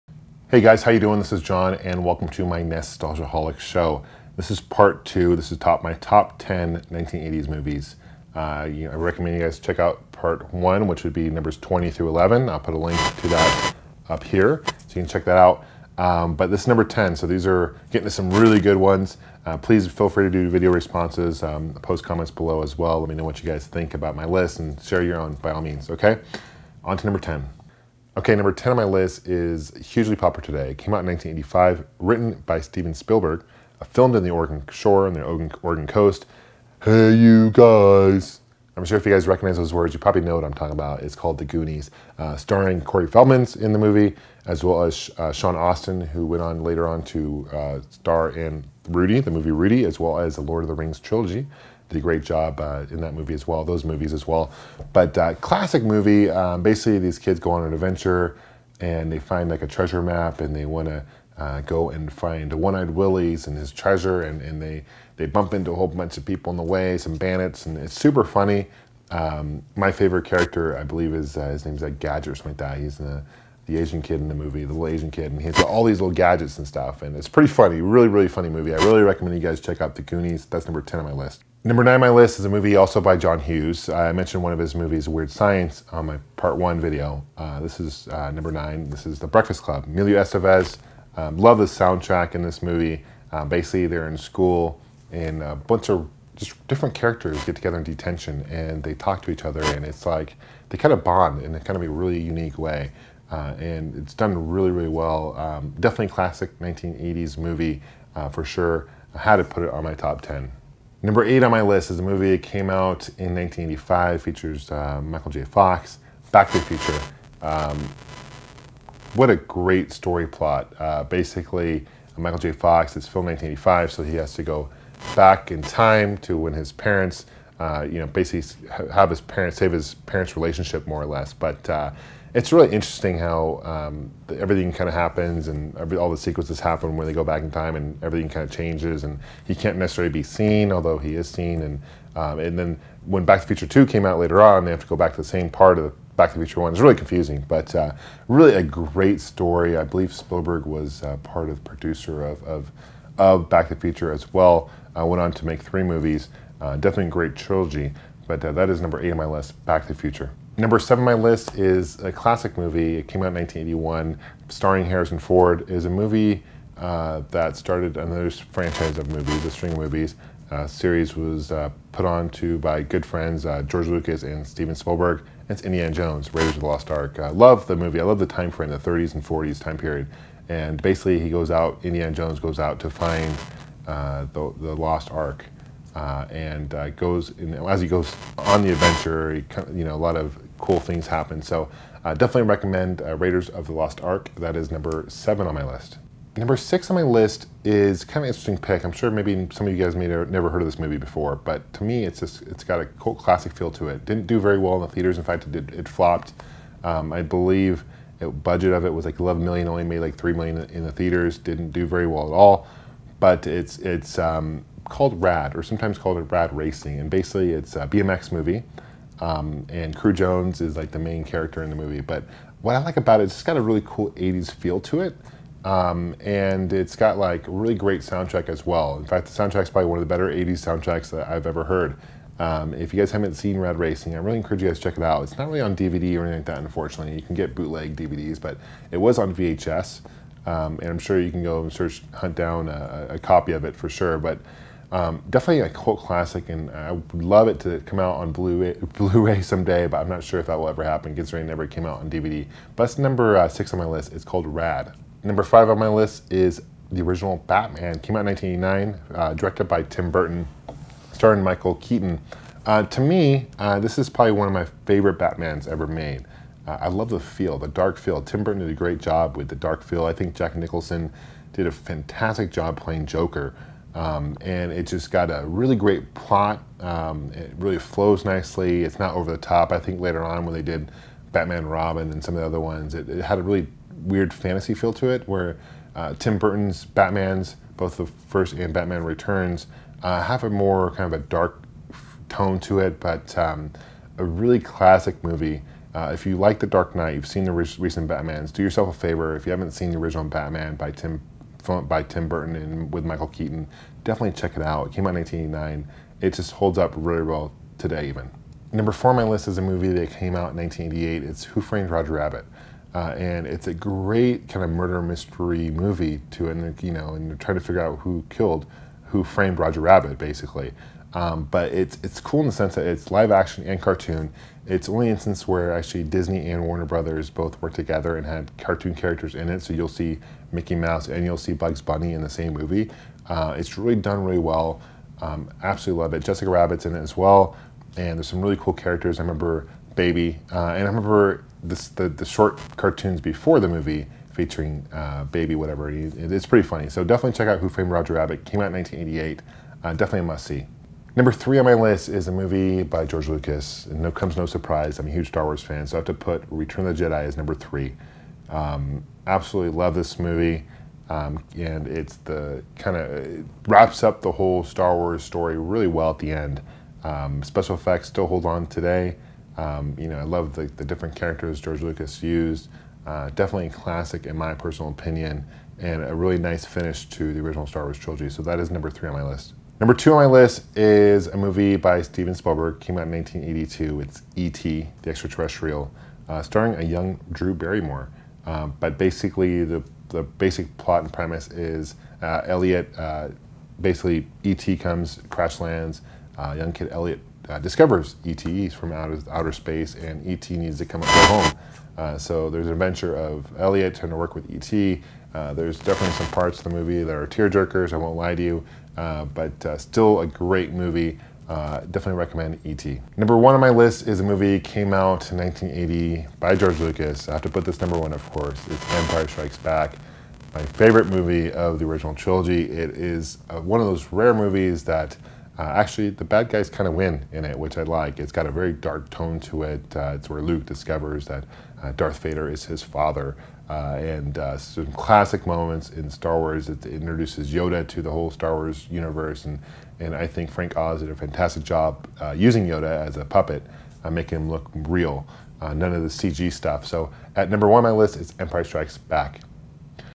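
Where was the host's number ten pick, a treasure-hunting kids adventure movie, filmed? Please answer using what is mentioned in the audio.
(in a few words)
Oregon coast.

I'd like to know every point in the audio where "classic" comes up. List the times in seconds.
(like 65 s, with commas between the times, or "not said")
55 s, 106 s, 162 s, 203 s, 245 s, 294 s, 373 s, 434 s.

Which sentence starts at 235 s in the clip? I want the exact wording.
It's not really on DVD or anything like that, unfortunately.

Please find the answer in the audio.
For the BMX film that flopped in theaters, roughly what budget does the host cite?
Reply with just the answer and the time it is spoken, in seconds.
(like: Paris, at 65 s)
11 million, at 209 s.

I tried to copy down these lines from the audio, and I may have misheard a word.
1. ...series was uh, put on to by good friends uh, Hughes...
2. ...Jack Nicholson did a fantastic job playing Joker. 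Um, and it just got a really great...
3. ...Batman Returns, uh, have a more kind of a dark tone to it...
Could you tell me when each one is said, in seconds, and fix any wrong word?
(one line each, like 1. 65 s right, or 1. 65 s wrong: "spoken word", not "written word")
1. 170 s wrong: "George", not "Hughes"
2. 270 s right
3. 288 s right.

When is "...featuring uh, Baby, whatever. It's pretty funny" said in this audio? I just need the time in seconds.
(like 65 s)
344 s.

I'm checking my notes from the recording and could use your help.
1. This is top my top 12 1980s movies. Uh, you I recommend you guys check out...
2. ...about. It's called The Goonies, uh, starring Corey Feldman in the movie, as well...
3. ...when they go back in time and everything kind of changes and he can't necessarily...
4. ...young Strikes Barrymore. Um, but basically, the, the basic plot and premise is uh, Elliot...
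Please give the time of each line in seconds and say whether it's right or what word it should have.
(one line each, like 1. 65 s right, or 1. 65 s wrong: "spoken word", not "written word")
1. 5 s wrong: "10", not "12"
2. 40 s right
3. 136 s right
4. 386 s wrong: "Drew", not "Strikes".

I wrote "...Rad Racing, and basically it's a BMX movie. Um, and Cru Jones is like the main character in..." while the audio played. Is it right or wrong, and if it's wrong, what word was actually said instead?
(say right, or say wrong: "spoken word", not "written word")
right.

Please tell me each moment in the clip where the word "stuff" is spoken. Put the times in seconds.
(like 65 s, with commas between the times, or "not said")
76 s, 446 s.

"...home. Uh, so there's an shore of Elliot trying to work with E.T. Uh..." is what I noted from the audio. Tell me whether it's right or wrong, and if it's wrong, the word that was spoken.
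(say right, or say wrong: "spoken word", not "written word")
wrong: "adventure", not "shore".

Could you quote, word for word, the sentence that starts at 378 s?
So that is number three on my list.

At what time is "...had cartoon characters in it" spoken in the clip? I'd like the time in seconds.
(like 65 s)
328 s.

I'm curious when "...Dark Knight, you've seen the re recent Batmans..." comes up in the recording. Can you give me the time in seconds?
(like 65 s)
296 s.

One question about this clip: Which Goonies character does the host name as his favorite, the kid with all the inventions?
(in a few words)
Gadget.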